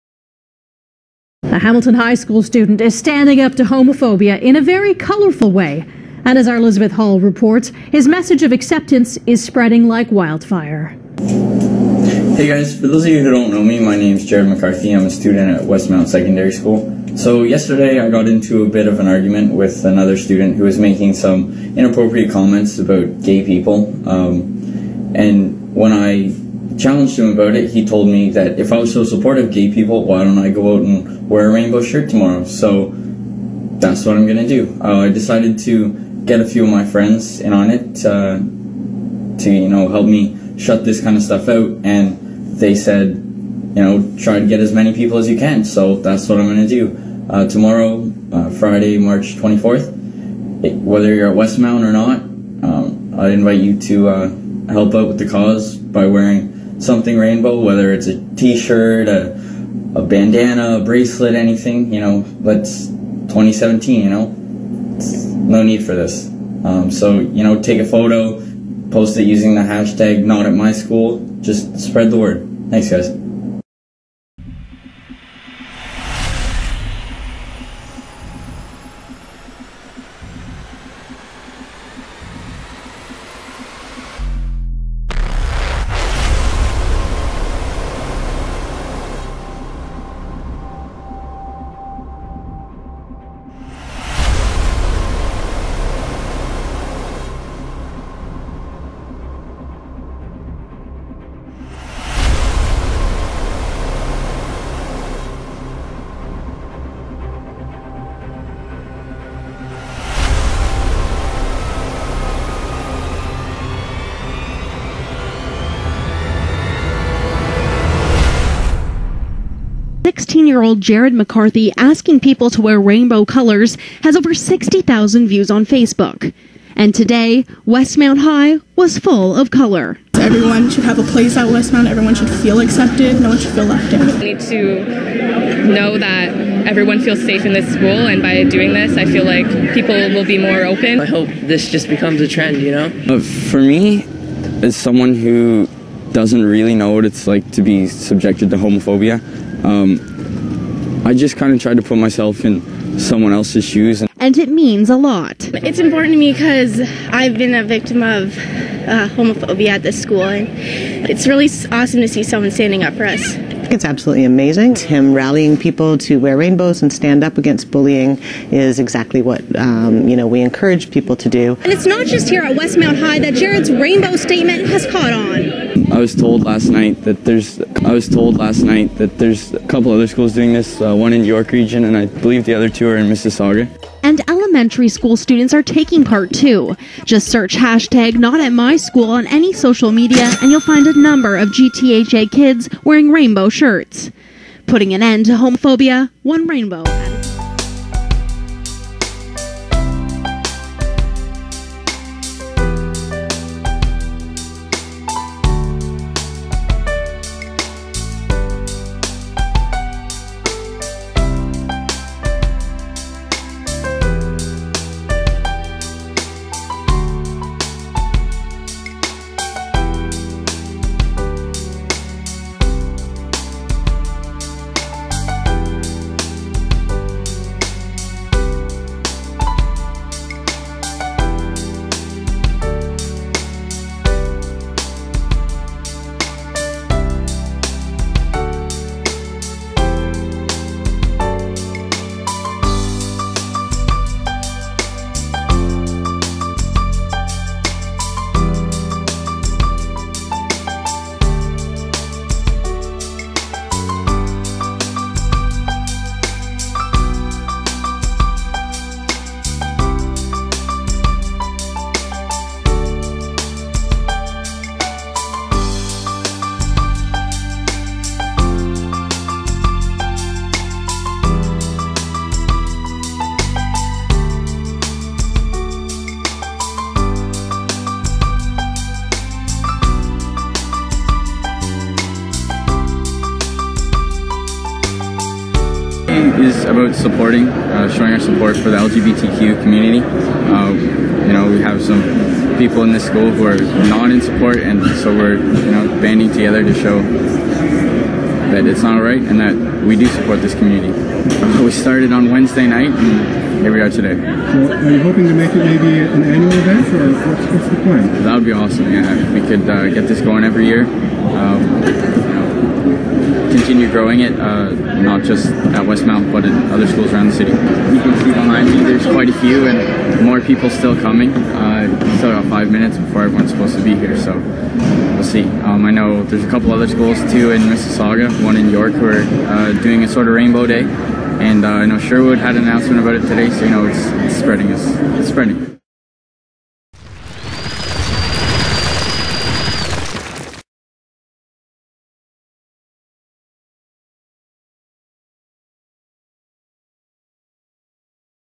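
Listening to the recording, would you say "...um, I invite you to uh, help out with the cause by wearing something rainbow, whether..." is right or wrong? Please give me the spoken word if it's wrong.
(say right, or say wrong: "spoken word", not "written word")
right.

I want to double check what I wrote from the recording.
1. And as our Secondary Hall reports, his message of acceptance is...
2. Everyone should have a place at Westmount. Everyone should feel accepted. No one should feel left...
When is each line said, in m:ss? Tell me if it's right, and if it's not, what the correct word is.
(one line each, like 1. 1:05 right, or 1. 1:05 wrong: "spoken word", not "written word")
1. 0:06 wrong: "Elizabeth", not "Secondary"
2. 2:10 right.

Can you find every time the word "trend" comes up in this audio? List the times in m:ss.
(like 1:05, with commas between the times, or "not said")
2:22.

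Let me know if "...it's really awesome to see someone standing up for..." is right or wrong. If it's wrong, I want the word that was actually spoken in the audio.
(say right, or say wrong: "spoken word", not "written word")
right.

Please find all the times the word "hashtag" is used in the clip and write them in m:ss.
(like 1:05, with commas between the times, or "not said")
1:09, 3:07.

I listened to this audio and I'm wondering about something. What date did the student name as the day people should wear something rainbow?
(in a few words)
Friday, March 24th.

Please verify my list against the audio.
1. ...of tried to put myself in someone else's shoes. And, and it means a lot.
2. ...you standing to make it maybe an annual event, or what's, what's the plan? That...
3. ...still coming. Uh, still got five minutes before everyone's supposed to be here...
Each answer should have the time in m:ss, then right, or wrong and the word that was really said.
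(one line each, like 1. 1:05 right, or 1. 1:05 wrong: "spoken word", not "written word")
1. 2:31 right
2. 5:04 wrong: "hoping", not "standing"
3. 5:20 right.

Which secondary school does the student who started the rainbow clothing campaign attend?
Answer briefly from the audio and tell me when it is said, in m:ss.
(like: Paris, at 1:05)
Westmount Secondary School, at 0:15.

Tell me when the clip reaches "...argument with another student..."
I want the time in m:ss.
0:19.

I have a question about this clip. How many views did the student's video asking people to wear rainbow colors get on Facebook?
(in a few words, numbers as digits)
Over 60,000.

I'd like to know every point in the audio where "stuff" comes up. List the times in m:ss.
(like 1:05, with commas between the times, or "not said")
0:41.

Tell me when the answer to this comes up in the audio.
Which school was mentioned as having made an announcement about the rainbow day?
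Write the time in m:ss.
5:31.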